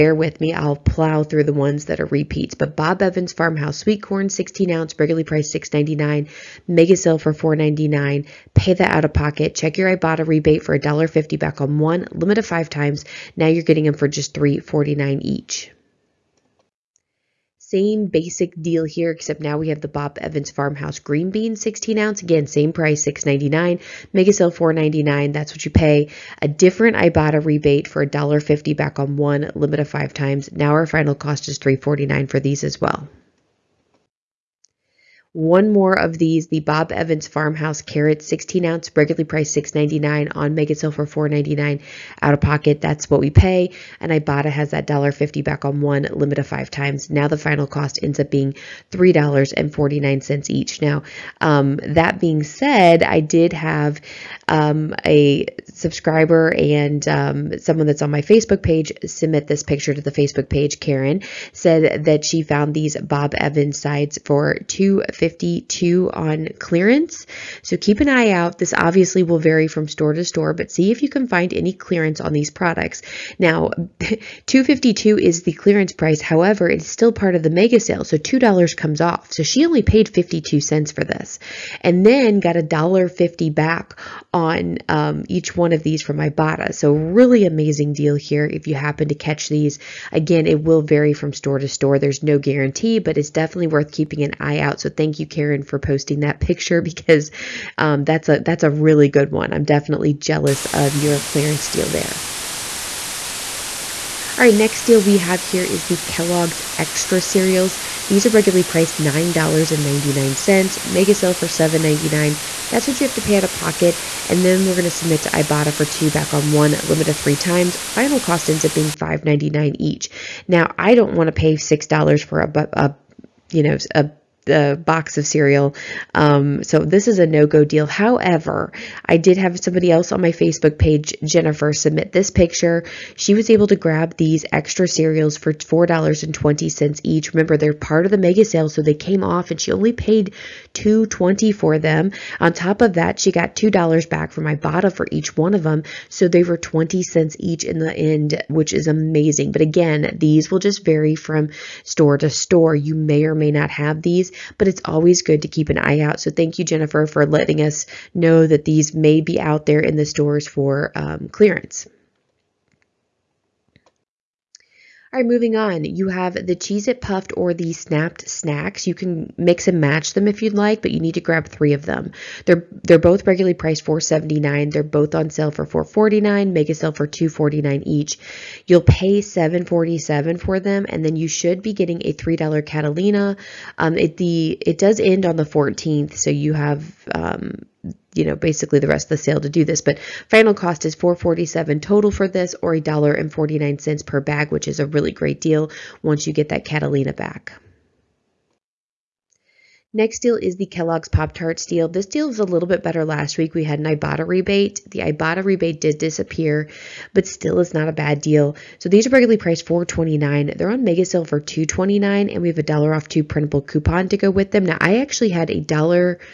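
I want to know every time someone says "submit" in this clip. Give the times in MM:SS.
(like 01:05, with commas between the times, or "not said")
00:59, 01:54, 02:11.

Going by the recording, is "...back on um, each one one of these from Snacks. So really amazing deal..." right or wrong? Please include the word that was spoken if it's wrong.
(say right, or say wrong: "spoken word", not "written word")
wrong: "Ibotta", not "Snacks".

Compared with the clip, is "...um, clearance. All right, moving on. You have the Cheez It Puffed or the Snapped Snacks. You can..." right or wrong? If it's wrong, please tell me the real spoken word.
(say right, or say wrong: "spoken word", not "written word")
right.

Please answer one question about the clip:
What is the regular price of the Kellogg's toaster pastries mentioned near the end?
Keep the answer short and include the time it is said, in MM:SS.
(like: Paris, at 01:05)
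$4.29, at 03:29.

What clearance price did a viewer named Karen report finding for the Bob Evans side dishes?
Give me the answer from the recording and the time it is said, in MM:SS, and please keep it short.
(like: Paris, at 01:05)
$2.52, at 01:04.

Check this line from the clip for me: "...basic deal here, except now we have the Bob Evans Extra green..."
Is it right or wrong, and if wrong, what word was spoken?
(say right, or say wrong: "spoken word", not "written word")
wrong: "Farmhouse", not "Extra".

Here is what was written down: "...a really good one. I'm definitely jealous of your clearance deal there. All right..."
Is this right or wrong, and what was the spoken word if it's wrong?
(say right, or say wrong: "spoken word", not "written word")
right.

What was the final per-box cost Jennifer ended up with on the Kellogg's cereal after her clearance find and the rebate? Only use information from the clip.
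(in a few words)
20 cents.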